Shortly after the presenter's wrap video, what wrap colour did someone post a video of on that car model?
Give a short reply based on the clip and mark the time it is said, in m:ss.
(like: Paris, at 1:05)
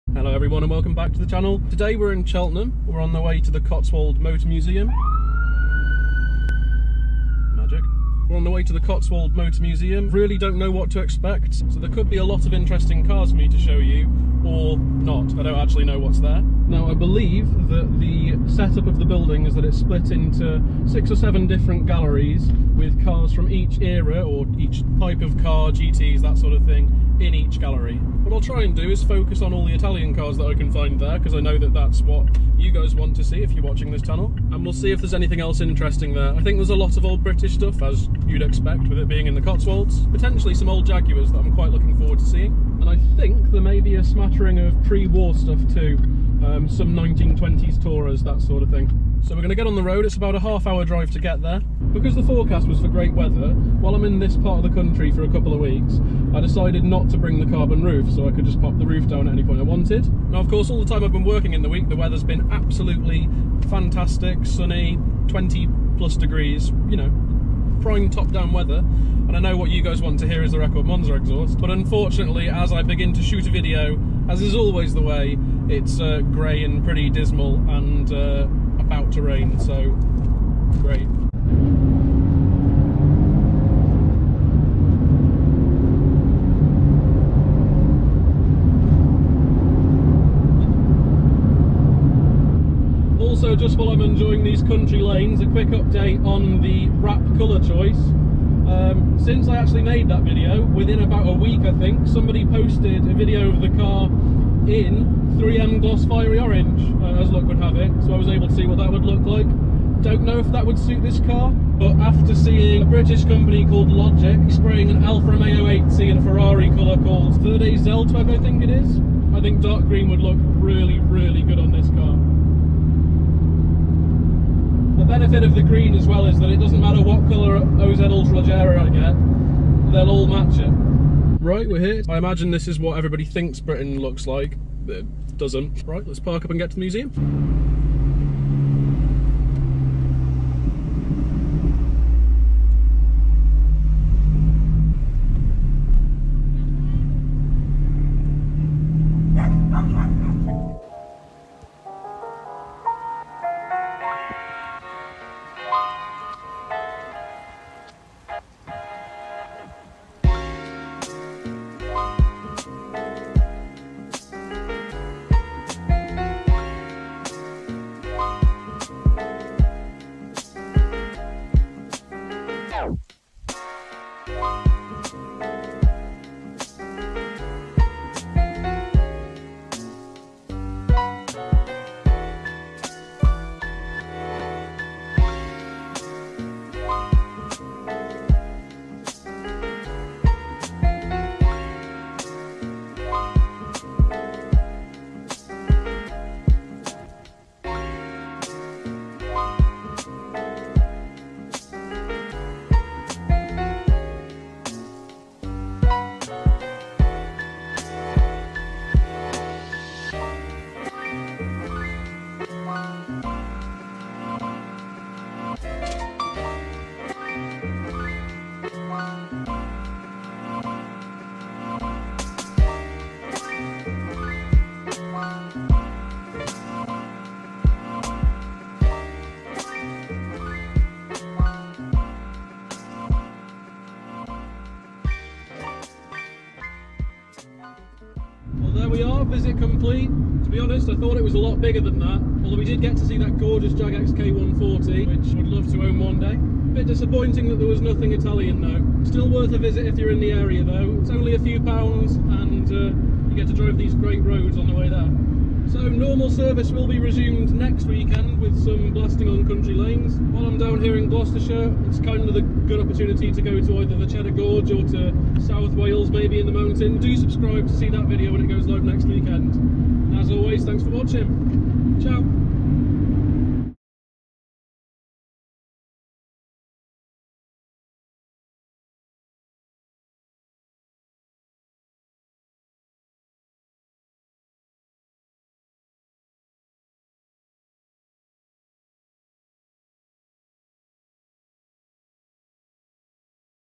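3M gloss fiery orange, at 1:45.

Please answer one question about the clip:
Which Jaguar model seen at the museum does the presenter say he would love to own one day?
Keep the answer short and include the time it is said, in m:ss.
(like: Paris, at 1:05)
XK140, at 4:03.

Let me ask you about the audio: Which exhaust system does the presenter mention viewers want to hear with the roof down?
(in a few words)
Record Monza.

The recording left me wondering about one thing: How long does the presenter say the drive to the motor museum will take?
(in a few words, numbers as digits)
half hour.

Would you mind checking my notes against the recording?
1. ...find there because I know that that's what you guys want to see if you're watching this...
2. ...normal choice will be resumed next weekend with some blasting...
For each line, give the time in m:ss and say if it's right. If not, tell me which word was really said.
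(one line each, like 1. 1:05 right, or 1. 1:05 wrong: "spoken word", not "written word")
1. 0:30 right
2. 4:15 wrong: "service", not "choice".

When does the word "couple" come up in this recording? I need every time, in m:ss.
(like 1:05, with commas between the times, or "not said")
0:55.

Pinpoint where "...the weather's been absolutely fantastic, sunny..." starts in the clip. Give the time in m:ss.
1:01.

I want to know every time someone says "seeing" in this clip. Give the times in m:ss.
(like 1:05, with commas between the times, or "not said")
0:42, 1:52.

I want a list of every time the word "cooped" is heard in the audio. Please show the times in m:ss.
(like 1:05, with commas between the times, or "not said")
not said.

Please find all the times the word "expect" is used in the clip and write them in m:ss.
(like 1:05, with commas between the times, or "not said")
0:10, 0:38.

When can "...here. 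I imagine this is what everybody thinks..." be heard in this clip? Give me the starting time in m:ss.
2:11.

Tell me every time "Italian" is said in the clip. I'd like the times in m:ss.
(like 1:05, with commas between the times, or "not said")
0:29, 4:08.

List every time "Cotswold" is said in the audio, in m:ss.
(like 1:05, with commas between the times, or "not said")
0:03, 0:08, 0:39.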